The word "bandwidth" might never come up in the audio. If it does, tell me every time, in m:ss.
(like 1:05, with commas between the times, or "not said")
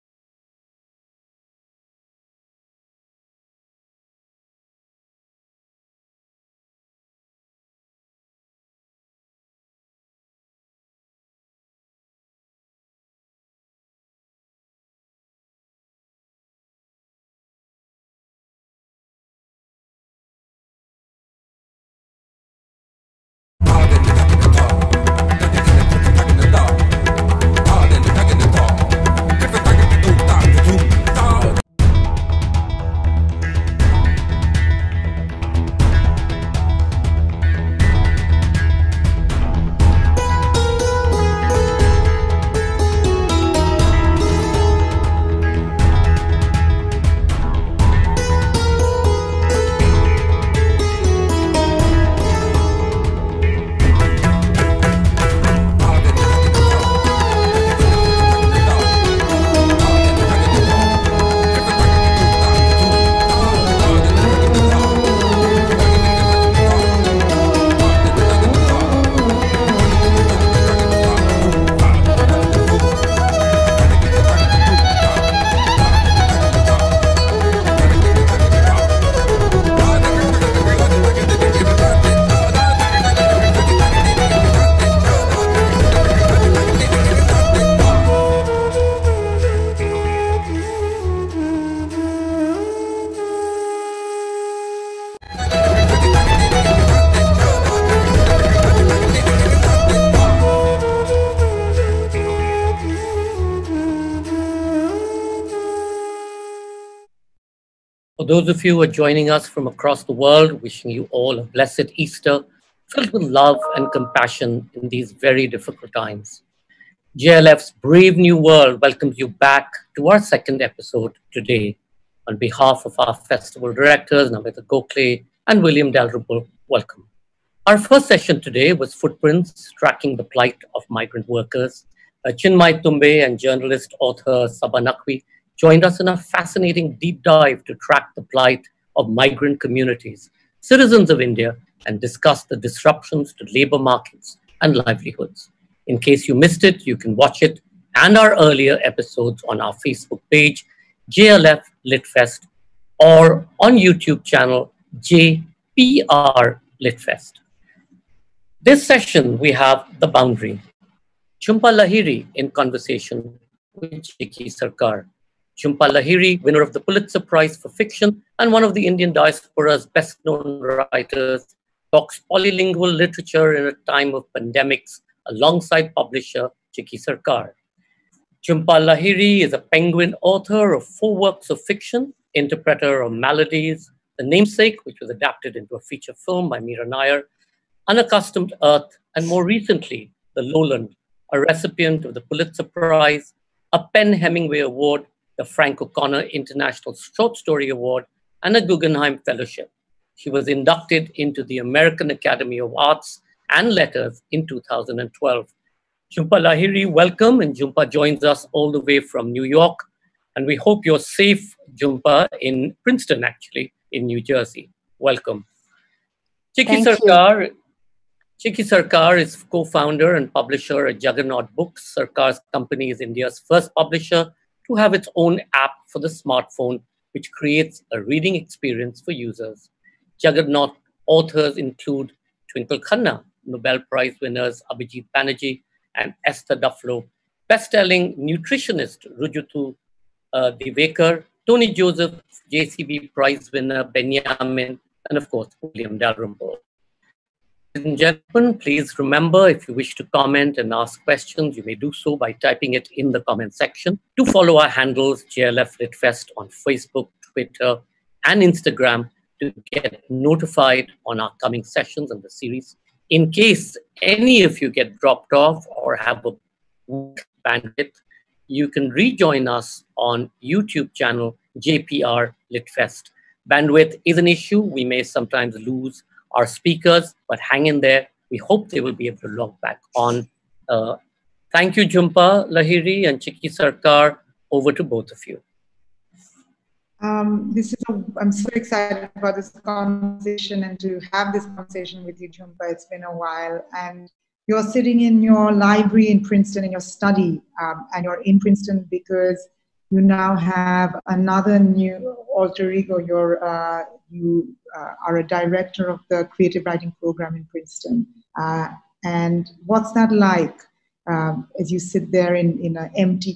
4:27, 4:33.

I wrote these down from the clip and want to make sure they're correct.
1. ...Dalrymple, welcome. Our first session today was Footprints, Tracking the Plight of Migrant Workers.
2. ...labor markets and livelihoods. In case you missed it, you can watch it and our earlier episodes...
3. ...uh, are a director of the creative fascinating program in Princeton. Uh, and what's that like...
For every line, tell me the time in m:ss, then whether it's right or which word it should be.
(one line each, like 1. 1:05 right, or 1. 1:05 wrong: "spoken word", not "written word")
1. 2:05 right
2. 2:23 right
3. 5:04 wrong: "writing", not "fascinating".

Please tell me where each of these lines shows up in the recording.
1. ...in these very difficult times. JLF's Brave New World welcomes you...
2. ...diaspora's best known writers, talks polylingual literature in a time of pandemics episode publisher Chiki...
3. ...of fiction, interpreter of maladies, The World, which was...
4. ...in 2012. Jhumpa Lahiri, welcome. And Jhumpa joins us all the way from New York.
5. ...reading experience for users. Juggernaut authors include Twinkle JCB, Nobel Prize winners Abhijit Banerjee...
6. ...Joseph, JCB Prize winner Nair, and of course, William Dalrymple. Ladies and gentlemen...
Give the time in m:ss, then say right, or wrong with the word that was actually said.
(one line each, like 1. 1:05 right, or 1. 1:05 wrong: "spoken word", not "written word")
1. 1:54 right
2. 2:49 wrong: "alongside", not "episode"
3. 3:01 wrong: "Namesake", not "World"
4. 3:24 right
5. 3:48 wrong: "Khanna", not "JCB"
6. 4:01 wrong: "Benjamin", not "Nair".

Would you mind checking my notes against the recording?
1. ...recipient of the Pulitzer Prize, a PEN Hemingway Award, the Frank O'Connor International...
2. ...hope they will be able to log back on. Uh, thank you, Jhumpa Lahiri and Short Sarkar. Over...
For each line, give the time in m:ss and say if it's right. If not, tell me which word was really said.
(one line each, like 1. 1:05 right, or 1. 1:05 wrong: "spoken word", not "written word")
1. 3:11 right
2. 4:38 wrong: "Chiki", not "Short".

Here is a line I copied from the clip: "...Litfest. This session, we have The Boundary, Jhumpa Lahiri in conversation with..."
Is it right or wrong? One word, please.
right.